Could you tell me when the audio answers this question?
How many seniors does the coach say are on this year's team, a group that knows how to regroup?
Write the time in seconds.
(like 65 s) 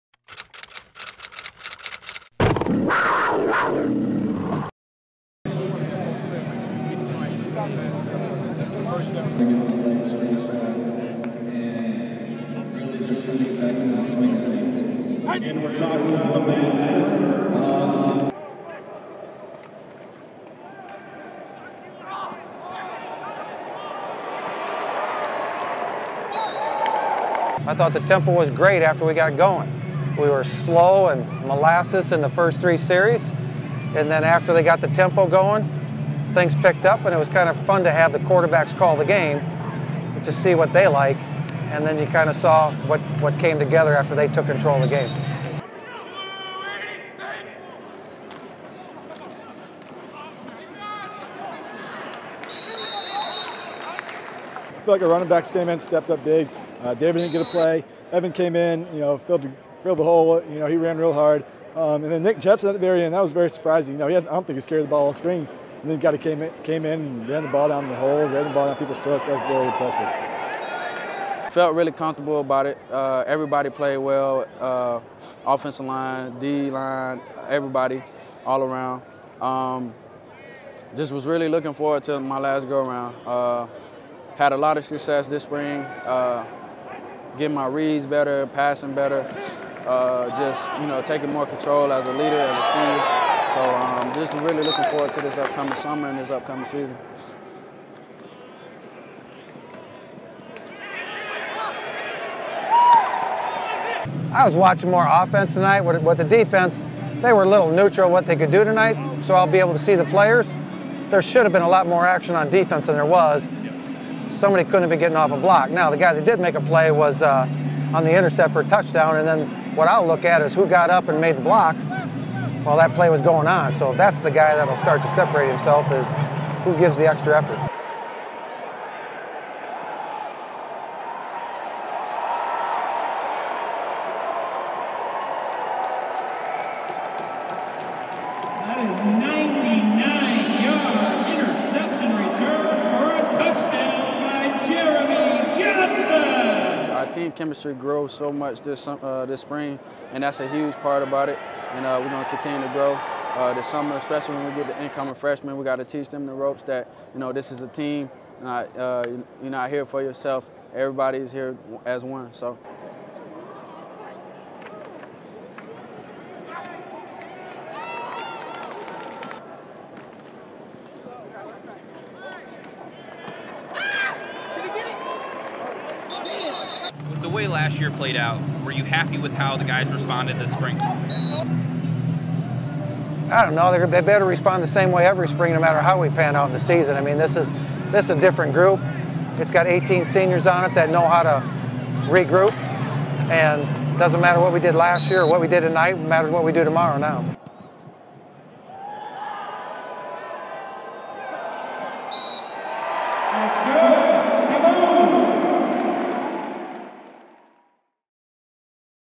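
189 s.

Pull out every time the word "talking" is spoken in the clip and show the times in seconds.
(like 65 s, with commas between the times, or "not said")
15 s.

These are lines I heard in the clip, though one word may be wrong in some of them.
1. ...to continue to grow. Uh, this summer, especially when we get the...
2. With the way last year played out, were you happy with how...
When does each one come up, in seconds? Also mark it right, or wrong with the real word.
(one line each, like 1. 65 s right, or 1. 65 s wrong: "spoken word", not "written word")
1. 152 s right
2. 177 s right.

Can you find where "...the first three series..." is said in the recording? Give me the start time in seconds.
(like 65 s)
32 s.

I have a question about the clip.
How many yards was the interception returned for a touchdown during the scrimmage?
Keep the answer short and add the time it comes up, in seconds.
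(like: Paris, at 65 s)
99, at 138 s.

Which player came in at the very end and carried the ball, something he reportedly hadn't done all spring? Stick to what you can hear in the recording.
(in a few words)
Nick Jepsen.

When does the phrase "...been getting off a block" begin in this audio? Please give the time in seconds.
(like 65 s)
114 s.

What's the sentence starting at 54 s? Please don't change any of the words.
I feel like our running back came in, stepped up big.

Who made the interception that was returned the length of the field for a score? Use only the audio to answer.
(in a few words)
Jeremy Johnson.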